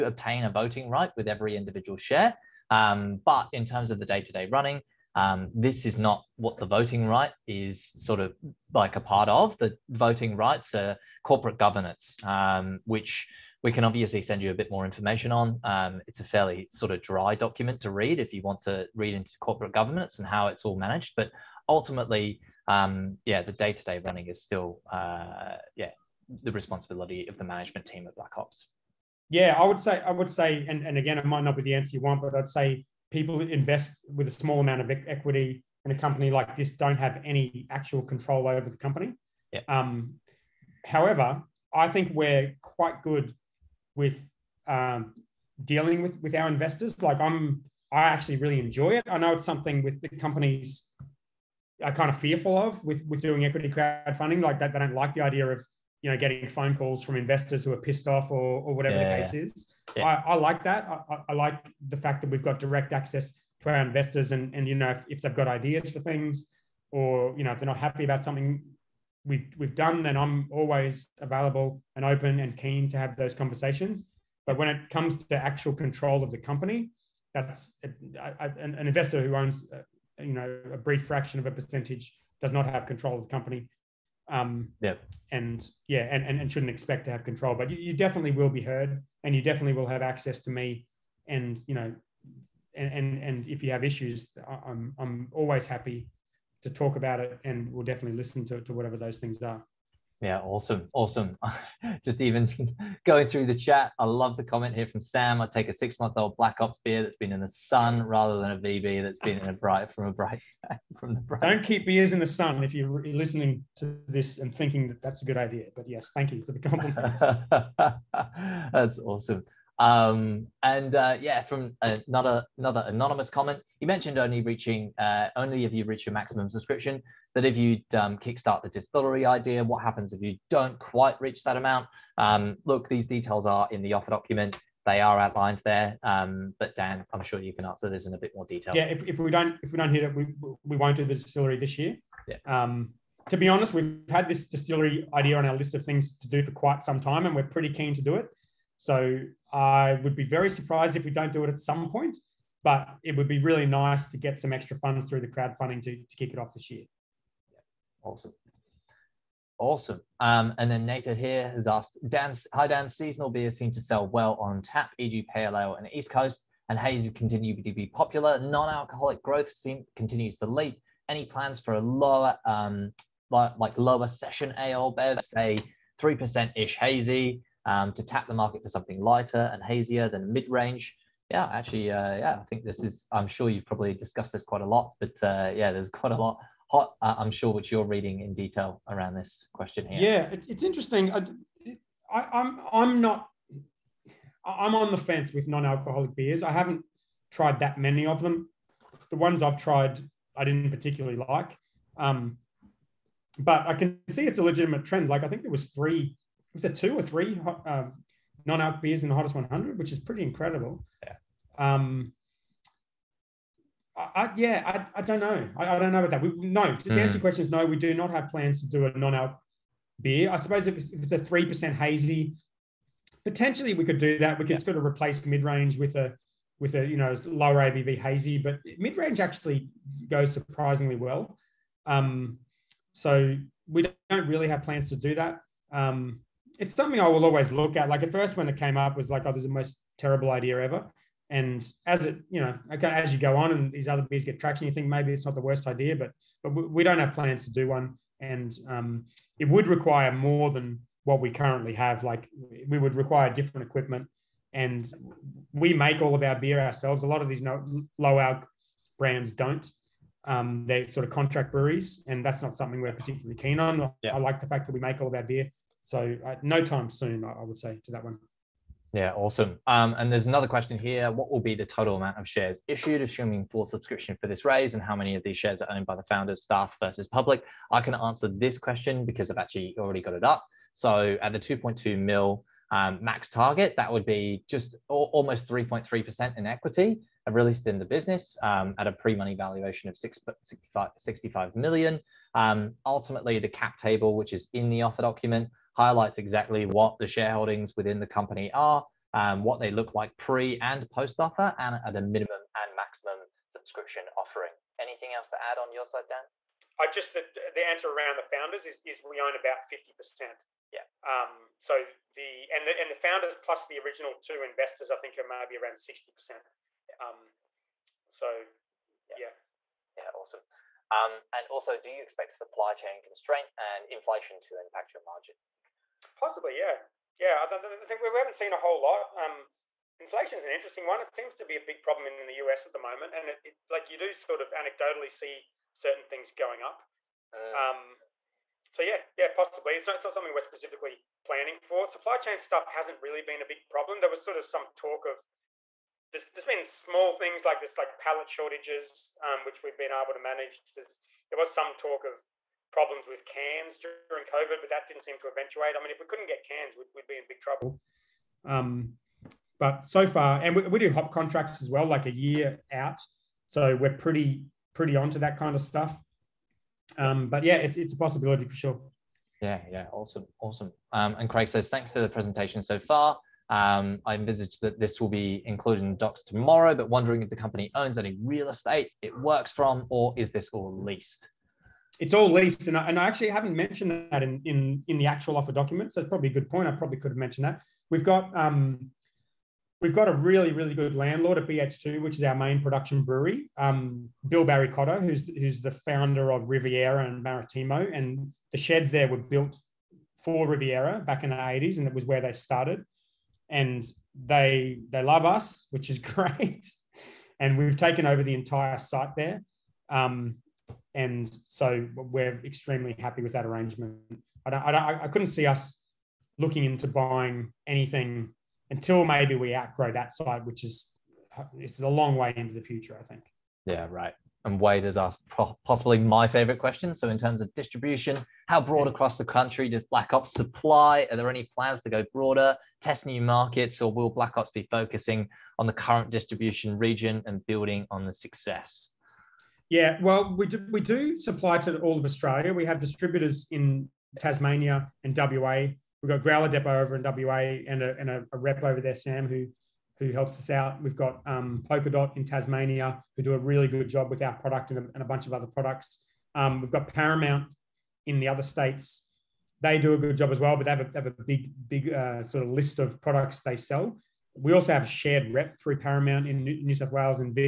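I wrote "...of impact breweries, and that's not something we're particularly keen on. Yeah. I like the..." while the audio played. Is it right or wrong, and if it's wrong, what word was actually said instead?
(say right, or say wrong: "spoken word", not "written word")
wrong: "contract", not "impact".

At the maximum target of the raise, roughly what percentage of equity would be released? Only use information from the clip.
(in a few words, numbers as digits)
3.3%.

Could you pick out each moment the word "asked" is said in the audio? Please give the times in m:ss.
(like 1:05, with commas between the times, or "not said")
2:41, 7:04.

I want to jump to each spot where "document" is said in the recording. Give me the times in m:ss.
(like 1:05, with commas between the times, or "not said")
0:17, 2:14, 4:55, 6:25.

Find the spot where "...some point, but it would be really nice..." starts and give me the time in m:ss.
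2:31.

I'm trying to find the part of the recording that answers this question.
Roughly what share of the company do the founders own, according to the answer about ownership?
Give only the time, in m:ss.
5:09.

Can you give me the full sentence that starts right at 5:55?
I mean, if we couldn't get cans, we'd, we'd be in big trouble.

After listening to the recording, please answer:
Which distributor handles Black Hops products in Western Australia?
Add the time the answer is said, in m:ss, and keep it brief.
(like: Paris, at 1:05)
Growler Depot, at 7:26.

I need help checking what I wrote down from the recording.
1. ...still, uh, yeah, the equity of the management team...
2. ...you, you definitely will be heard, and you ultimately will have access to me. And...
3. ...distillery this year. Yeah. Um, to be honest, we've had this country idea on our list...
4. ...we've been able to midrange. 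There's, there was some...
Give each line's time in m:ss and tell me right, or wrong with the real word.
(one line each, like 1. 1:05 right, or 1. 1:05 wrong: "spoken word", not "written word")
1. 0:24 wrong: "responsibility", not "equity"
2. 1:27 wrong: "definitely", not "ultimately"
3. 2:21 wrong: "distillery", not "country"
4. 5:49 wrong: "manage", not "midrange".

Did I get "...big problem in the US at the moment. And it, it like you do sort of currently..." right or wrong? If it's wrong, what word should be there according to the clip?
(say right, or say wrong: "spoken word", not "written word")
wrong: "anecdotally", not "currently".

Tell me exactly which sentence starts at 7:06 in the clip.
So, in terms of distribution, how broad across the country does Black Hops supply?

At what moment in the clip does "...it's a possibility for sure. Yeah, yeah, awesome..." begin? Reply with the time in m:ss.
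6:07.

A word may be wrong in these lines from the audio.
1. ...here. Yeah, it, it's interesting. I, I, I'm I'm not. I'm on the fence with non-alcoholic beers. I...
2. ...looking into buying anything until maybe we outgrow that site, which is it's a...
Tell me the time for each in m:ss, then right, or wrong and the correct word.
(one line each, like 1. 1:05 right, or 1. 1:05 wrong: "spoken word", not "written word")
1. 3:09 right
2. 6:56 right.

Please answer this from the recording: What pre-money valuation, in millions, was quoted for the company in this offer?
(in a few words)
65 million.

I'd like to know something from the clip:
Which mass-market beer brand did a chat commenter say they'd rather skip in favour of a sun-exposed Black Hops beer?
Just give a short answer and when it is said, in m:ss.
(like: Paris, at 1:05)
VB, at 1:48.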